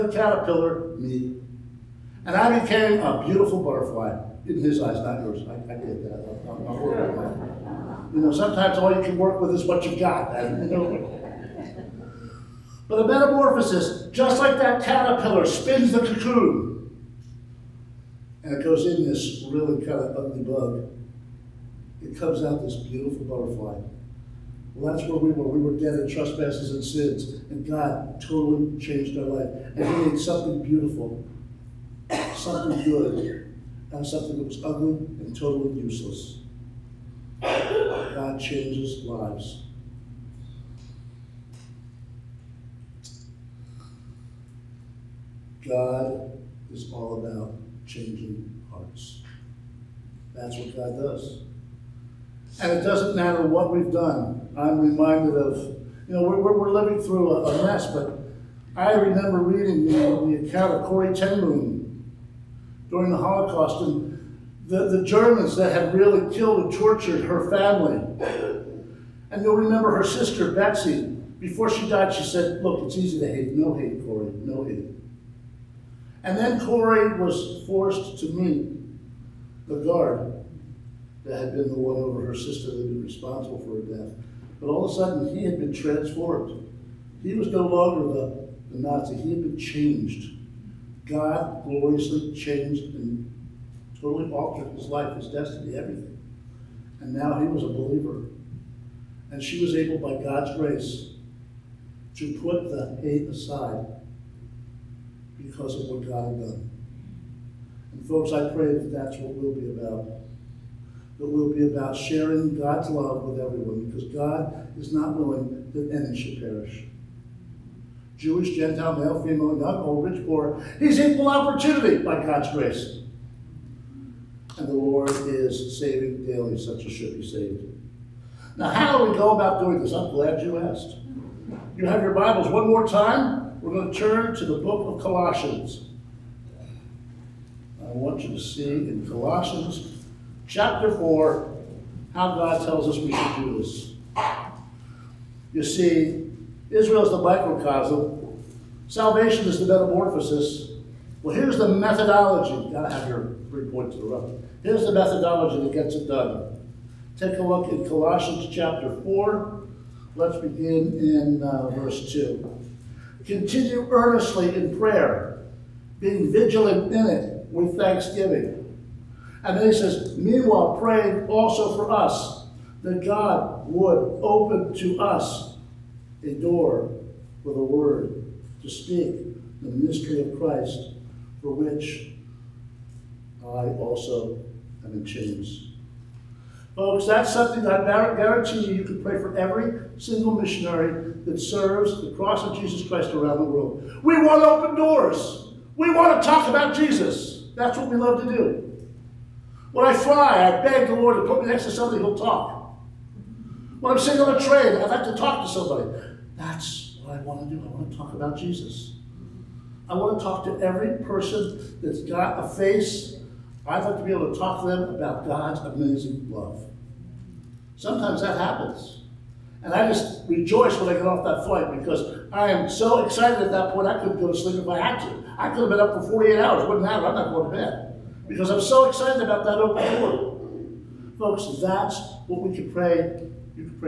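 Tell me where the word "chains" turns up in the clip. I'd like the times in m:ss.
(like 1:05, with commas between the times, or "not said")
3:05.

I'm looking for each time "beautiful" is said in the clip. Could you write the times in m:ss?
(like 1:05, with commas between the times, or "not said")
0:03, 0:22, 0:30.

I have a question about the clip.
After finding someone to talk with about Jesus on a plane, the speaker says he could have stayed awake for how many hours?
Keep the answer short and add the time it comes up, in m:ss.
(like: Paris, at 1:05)
48, at 3:46.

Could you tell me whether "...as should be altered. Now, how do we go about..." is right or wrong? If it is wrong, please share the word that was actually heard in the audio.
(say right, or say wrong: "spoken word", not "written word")
wrong: "saved", not "altered".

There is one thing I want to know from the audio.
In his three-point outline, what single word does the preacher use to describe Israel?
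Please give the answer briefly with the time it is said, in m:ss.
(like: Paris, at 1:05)
microcosm, at 2:27.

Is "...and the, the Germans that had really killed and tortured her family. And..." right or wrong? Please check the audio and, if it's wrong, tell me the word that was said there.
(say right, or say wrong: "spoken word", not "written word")
right.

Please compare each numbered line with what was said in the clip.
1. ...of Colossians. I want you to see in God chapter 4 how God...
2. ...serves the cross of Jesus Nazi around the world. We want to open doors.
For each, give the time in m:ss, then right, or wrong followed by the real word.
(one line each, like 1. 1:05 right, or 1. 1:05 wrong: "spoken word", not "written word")
1. 2:14 wrong: "Colossians", not "God"
2. 3:11 wrong: "Christ", not "Nazi".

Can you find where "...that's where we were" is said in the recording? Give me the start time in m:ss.
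0:24.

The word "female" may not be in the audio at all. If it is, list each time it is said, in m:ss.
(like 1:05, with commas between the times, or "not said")
1:59.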